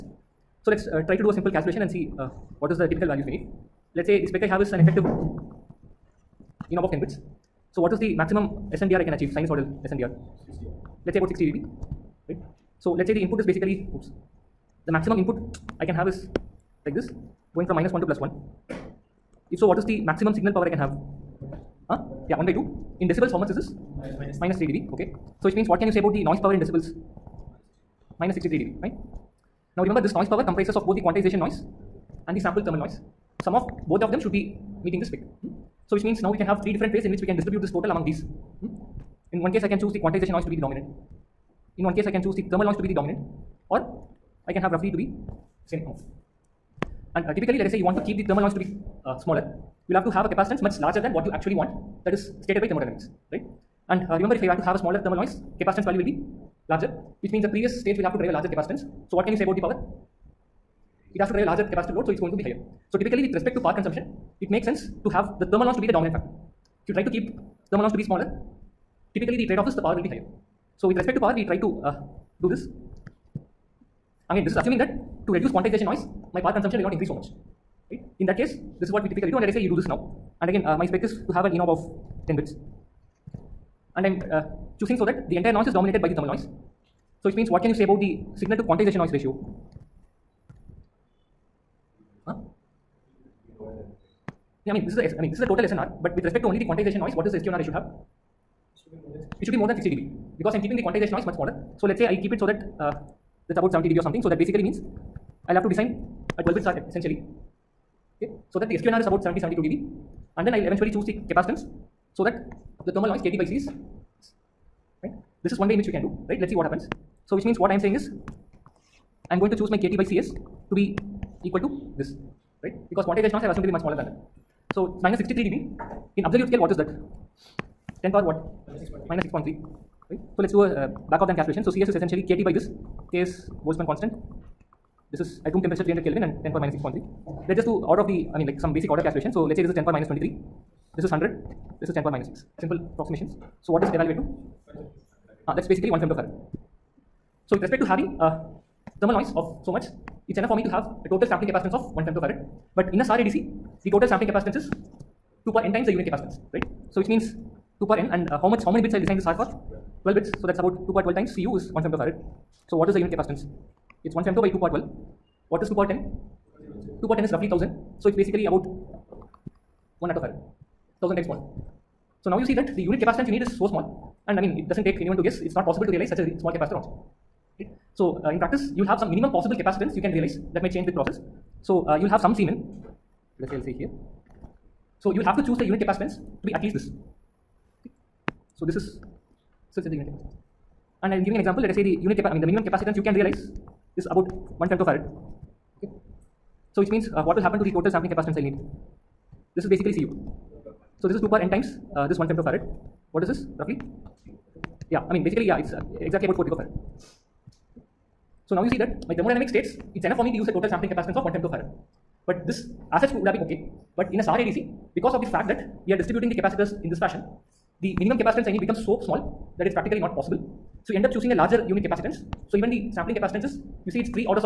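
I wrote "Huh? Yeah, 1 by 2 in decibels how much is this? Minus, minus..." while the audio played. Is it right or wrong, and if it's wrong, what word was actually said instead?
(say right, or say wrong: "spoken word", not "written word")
right.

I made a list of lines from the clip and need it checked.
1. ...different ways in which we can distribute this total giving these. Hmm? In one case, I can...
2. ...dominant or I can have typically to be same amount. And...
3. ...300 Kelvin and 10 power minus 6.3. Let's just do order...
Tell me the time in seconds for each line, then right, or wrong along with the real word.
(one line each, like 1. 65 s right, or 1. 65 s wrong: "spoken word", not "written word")
1. 36 s wrong: "among", not "giving"
2. 42 s wrong: "roughly", not "typically"
3. 135 s right.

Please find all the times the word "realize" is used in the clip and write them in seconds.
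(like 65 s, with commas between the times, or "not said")
175 s, 180 s, 193 s.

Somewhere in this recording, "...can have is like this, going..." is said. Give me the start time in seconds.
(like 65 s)
15 s.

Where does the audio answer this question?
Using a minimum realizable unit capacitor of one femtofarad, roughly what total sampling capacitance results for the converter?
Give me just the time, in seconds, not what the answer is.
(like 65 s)
206 s.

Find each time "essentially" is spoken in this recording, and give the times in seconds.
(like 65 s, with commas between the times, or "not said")
106 s, 131 s.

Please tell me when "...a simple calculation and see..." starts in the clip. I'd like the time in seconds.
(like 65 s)
1 s.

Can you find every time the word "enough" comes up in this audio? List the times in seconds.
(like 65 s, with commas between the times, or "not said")
150 s, 210 s.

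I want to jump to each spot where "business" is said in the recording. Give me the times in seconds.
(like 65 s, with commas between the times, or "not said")
not said.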